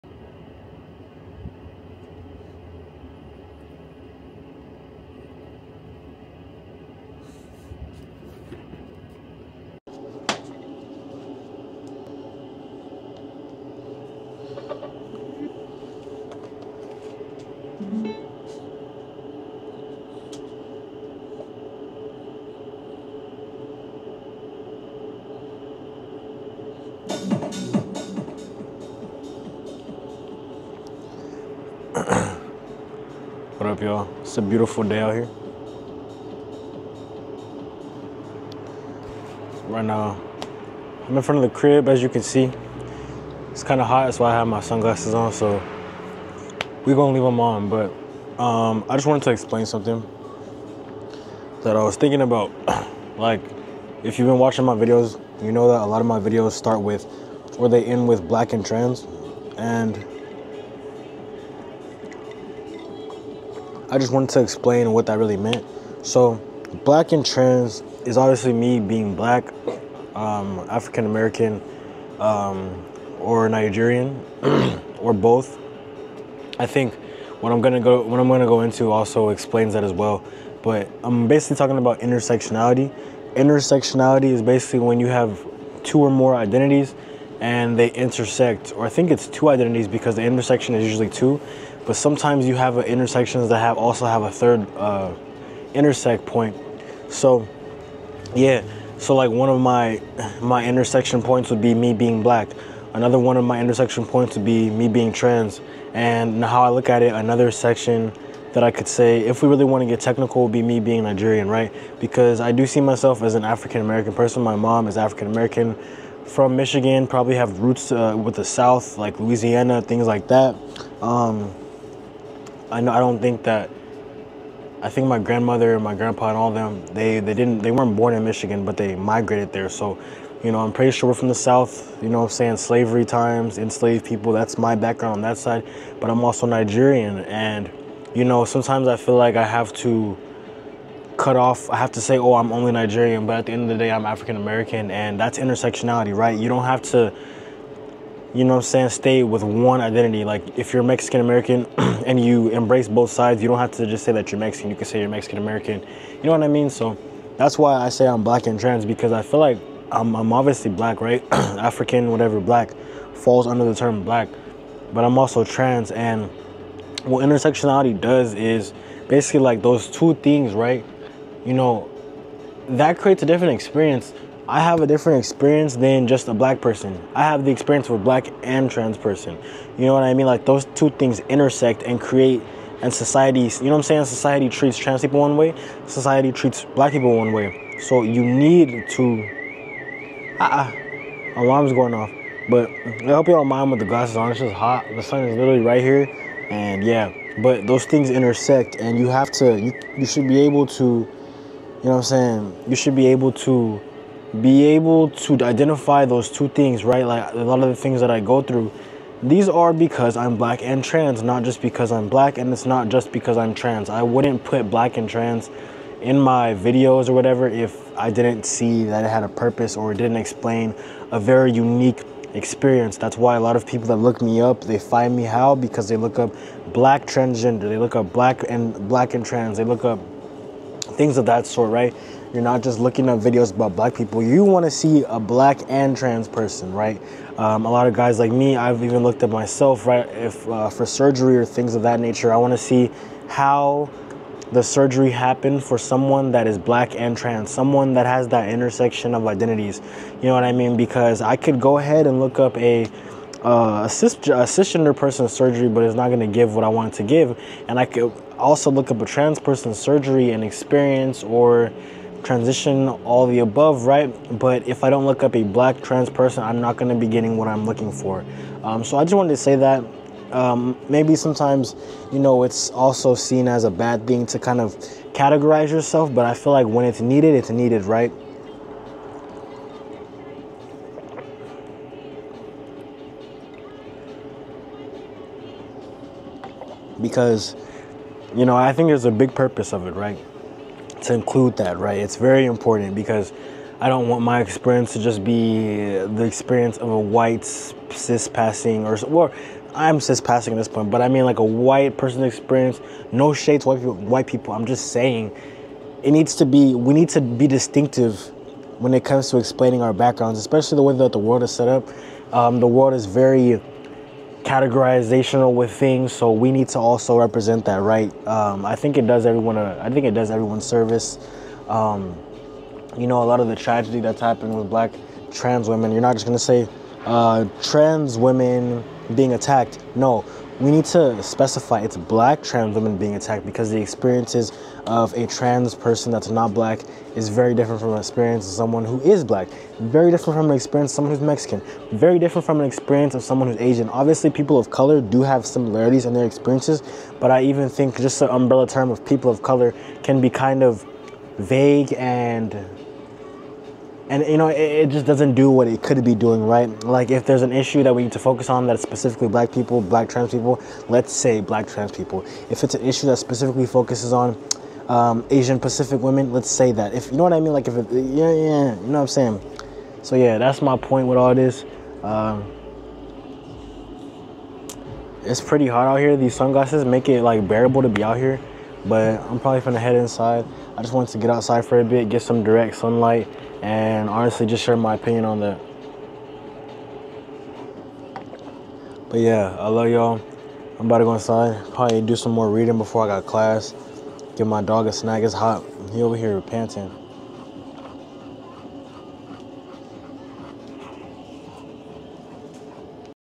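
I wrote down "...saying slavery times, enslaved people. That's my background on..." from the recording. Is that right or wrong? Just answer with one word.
right.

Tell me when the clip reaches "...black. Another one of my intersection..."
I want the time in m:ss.
1:42.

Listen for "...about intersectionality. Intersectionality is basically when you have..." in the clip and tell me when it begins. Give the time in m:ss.
1:21.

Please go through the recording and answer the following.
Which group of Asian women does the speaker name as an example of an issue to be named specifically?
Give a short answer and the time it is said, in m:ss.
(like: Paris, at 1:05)
Asian Pacific women, at 6:05.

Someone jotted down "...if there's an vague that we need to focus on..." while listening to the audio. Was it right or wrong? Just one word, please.
wrong.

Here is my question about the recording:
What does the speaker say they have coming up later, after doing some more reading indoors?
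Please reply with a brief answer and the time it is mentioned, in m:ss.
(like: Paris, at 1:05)
Class, at 6:33.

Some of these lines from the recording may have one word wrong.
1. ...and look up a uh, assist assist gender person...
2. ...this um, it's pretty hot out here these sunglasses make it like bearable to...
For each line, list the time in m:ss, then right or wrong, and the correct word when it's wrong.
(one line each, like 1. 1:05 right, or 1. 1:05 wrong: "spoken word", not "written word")
1. 4:12 right
2. 6:11 right.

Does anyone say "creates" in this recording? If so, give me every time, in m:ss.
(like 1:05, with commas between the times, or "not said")
2:52, 3:02.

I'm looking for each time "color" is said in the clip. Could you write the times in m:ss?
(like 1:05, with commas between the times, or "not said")
5:44, 5:49.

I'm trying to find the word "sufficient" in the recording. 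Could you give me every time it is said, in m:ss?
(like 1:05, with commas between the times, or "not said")
not said.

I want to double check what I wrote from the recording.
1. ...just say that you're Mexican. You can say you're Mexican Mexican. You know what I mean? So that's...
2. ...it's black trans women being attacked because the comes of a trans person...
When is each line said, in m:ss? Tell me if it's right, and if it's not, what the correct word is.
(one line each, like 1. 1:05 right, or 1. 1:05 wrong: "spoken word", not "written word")
1. 2:33 wrong: "American", not "Mexican"
2. 5:31 wrong: "experiences", not "comes".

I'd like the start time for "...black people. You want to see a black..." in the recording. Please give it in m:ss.
3:53.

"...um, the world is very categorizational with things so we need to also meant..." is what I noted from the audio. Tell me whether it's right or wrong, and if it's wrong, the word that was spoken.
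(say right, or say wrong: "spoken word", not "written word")
wrong: "represent", not "meant".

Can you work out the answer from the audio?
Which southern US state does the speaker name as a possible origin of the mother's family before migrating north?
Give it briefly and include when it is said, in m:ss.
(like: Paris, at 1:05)
Louisiana, at 1:59.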